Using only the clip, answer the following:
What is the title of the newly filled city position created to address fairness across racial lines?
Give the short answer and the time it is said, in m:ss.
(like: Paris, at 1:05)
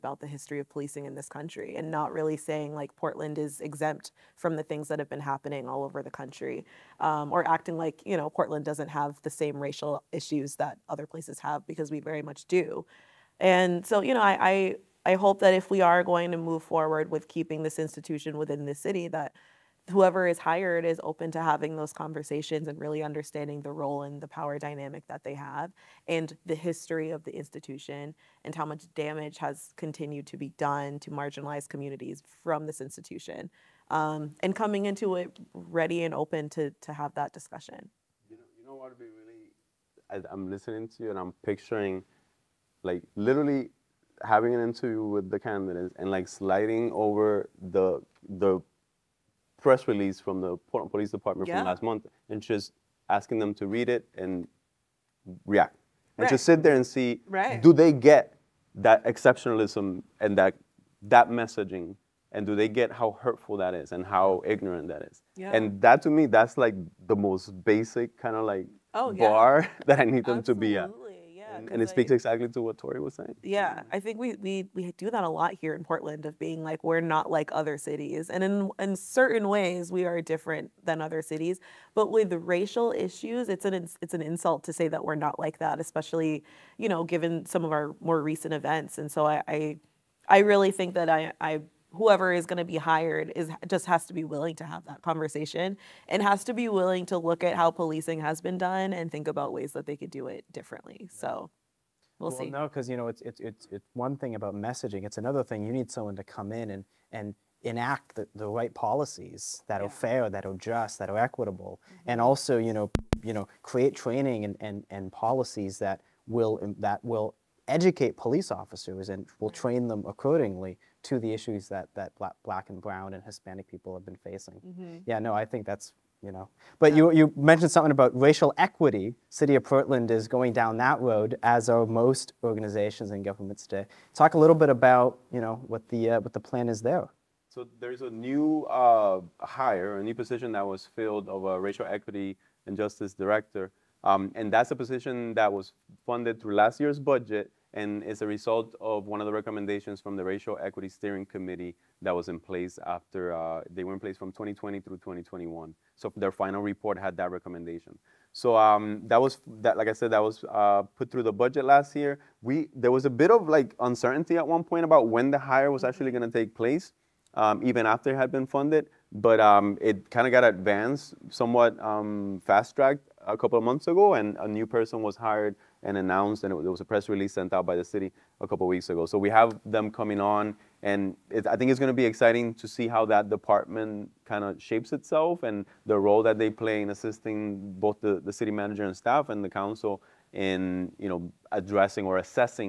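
racial equity and justice director, at 2:21.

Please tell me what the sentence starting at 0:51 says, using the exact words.
from last month and just asking them to read it and react.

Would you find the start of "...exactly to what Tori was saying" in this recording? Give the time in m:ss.
1:12.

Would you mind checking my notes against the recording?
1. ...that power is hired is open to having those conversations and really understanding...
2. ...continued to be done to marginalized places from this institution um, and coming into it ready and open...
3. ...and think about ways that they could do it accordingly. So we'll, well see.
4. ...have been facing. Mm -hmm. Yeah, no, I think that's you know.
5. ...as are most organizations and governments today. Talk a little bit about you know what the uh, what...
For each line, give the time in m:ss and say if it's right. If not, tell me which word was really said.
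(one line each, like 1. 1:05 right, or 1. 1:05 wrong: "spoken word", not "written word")
1. 0:19 wrong: "whoever", not "power"
2. 0:29 wrong: "communities", not "places"
3. 1:38 wrong: "differently", not "accordingly"
4. 2:03 right
5. 2:11 right.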